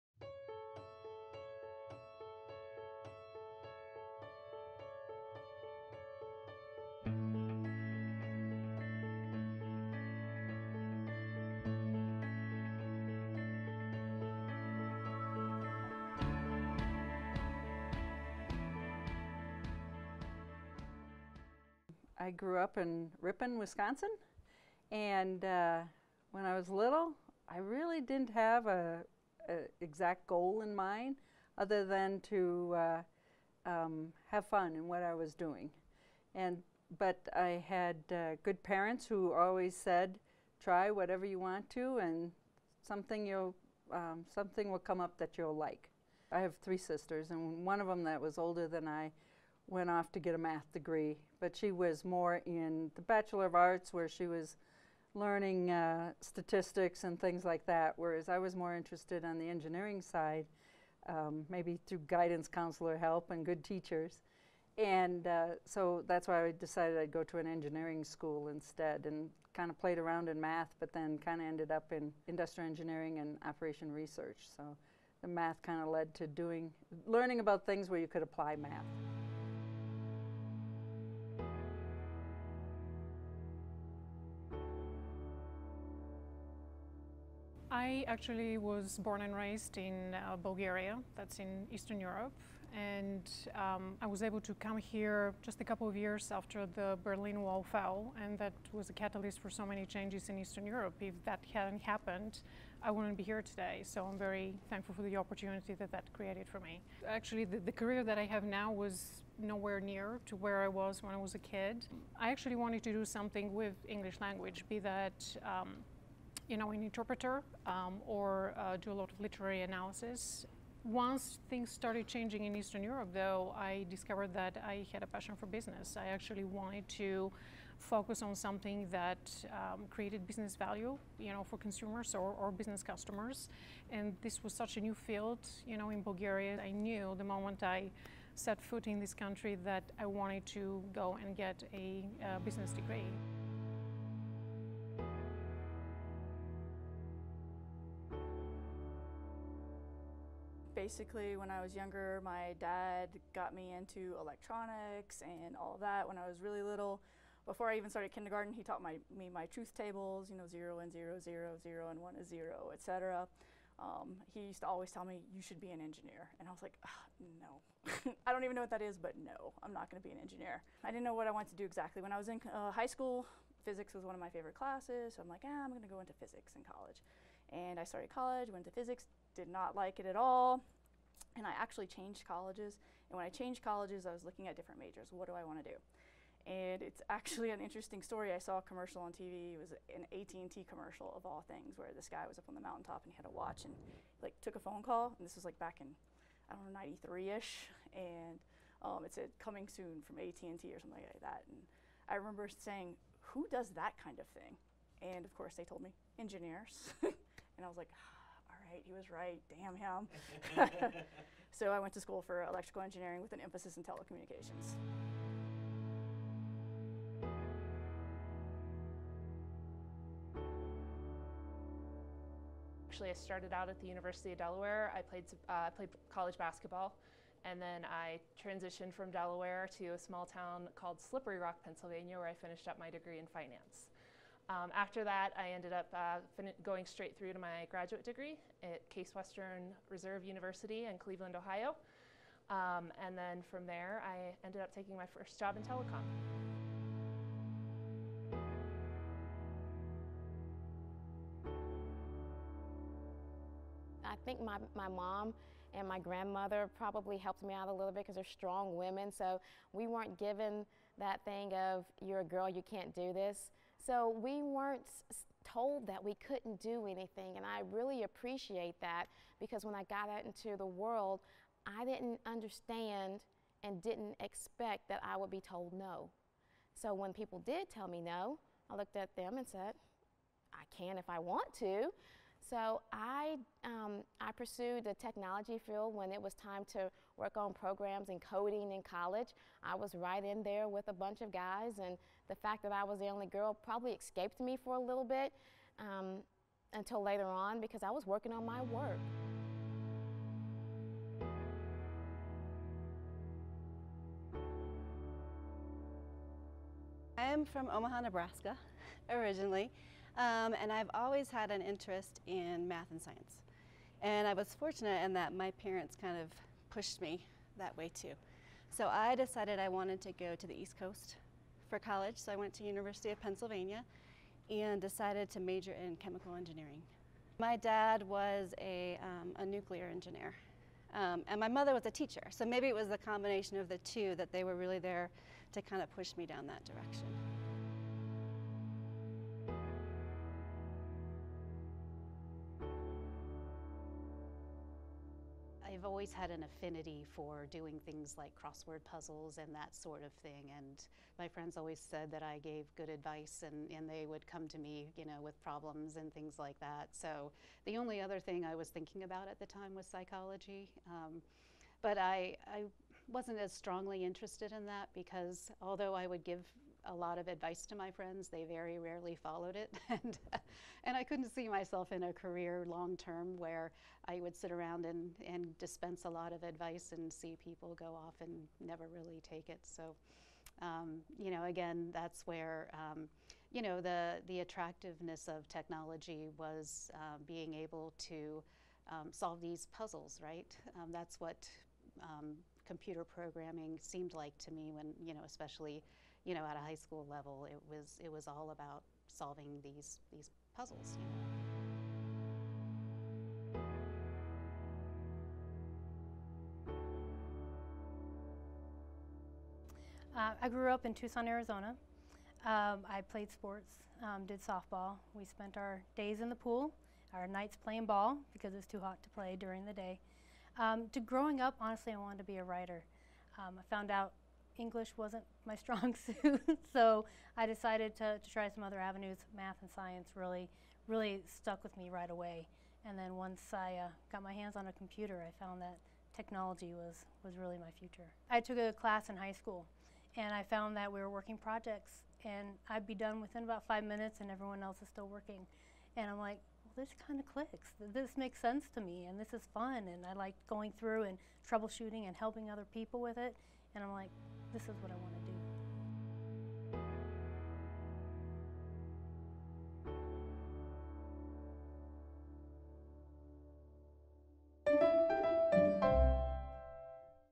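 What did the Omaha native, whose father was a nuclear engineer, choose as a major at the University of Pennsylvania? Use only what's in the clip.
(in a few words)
chemical engineering.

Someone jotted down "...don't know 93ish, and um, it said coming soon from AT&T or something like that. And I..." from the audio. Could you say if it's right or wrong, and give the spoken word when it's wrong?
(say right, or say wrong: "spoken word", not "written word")
right.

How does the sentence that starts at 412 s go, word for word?
Um, I played sports, um, did softball.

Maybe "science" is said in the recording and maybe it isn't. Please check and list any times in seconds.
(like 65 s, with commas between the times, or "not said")
313 s, 429 s.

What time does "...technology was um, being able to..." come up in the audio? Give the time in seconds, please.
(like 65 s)
385 s.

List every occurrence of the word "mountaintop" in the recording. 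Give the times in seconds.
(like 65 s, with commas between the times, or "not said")
192 s.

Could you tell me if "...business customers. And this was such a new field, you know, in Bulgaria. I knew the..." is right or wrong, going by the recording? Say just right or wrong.
right.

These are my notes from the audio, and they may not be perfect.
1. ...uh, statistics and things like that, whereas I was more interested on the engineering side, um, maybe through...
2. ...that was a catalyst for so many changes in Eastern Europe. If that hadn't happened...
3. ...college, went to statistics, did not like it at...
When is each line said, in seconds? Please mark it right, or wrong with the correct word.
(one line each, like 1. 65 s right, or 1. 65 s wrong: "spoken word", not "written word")
1. 55 s right
2. 98 s right
3. 178 s wrong: "physics", not "statistics".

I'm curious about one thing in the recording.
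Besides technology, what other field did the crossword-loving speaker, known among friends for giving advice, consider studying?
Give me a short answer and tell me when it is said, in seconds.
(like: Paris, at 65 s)
psychology, at 359 s.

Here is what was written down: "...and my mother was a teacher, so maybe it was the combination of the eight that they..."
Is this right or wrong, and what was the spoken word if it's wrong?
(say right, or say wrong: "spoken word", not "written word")
wrong: "two", not "eight".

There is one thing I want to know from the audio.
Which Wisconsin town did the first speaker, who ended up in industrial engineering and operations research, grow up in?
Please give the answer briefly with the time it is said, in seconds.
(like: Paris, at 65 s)
Ripon, at 23 s.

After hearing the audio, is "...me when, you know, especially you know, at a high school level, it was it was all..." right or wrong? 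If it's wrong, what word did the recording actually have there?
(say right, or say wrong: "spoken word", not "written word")
right.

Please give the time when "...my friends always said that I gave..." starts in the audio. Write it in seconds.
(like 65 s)
351 s.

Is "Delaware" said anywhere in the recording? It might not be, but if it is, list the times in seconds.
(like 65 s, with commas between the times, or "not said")
224 s, 229 s.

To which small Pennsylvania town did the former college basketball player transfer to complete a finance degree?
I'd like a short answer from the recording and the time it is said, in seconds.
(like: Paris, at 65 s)
Slippery Rock, at 230 s.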